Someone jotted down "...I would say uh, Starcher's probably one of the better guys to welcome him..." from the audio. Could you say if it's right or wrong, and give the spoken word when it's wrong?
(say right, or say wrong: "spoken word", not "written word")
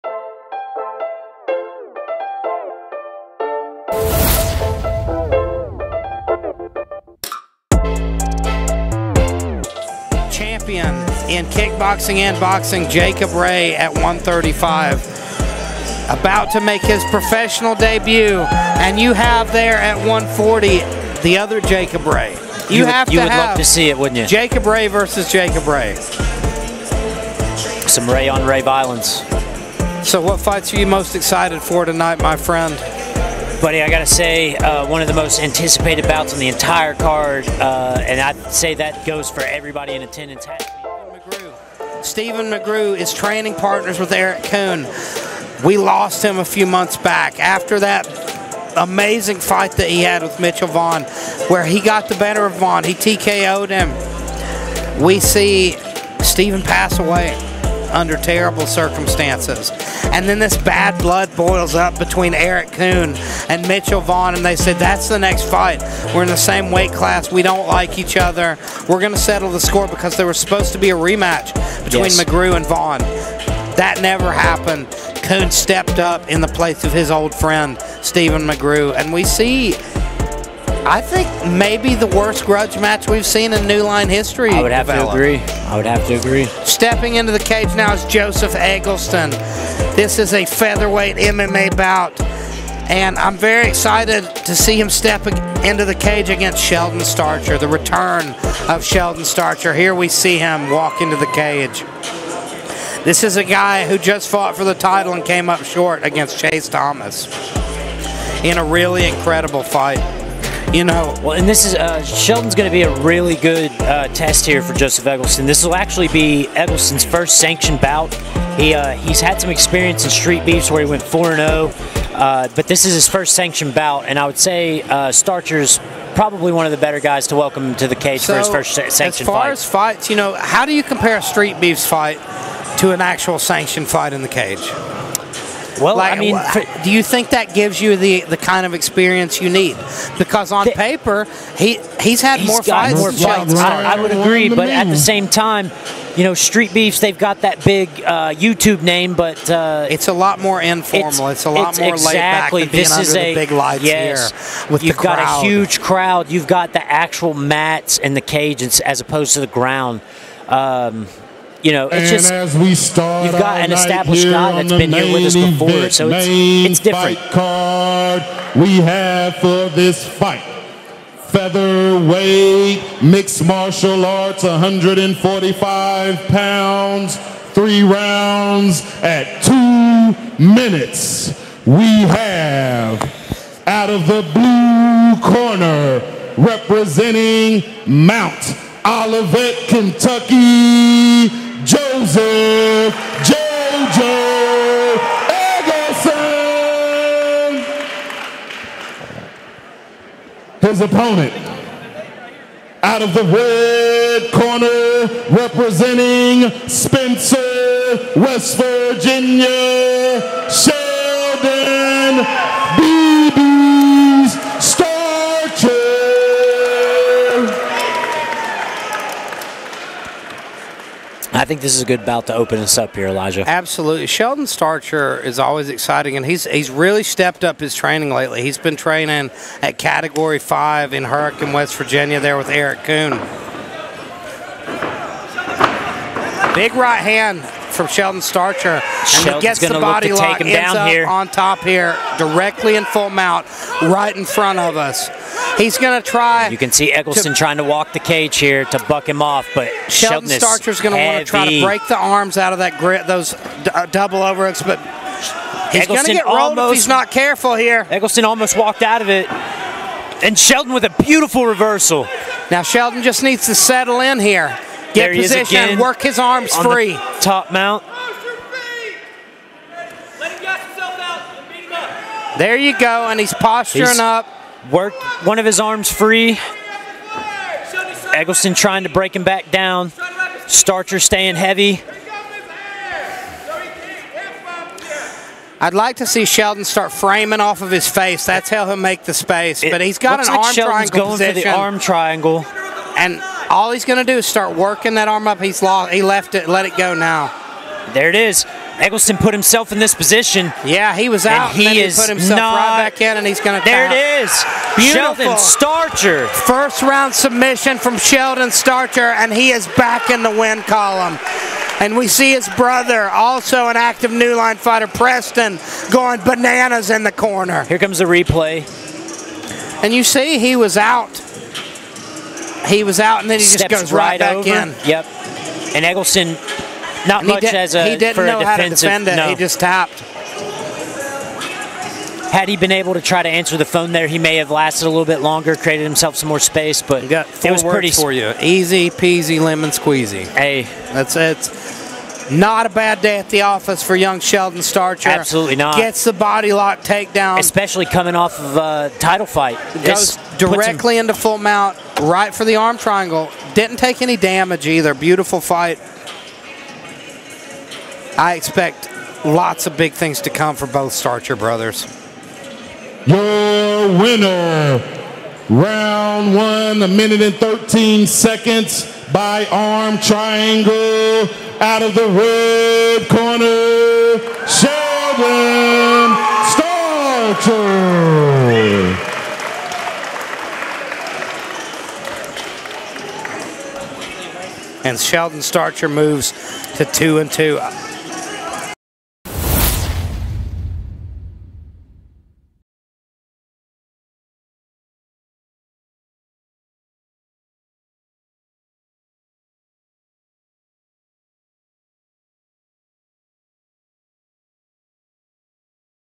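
right.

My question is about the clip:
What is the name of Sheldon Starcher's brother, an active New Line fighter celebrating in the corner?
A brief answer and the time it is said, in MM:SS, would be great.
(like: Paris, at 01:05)
Preston, at 05:14.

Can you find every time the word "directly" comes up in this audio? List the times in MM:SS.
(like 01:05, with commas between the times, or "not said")
04:02, 05:50.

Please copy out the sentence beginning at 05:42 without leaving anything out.
Not a bad day at the office for young Sheldon Starcher.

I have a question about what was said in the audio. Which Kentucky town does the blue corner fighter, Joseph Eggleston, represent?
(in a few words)
Mount Olivet.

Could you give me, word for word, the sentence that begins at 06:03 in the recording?
Your winner, round one, a minute and 13 seconds by arm triangle out of the red corner, Sheldon Starcher.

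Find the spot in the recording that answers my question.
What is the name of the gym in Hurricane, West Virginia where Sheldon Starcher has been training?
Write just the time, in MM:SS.
03:49.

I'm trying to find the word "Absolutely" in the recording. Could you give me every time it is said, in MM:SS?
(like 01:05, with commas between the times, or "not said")
03:43, 05:45.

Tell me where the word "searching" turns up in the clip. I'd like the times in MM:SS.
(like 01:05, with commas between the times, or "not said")
not said.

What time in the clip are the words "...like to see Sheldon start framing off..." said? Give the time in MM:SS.
04:45.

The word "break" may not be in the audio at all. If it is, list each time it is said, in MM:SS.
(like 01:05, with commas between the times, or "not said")
04:11, 04:38.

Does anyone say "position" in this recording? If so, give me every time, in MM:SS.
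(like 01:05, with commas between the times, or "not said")
04:25, 04:51, 04:59.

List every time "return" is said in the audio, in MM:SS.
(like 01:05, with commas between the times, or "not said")
01:37.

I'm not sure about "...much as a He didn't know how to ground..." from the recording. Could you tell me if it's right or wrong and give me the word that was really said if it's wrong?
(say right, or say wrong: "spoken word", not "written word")
wrong: "defend", not "ground".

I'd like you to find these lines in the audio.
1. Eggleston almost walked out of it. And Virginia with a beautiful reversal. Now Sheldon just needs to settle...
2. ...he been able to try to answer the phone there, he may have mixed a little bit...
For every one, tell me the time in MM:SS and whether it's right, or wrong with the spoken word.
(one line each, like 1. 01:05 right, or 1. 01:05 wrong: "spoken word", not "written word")
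1. 04:17 wrong: "Sheldon", not "Virginia"
2. 05:32 wrong: "lasted", not "mixed".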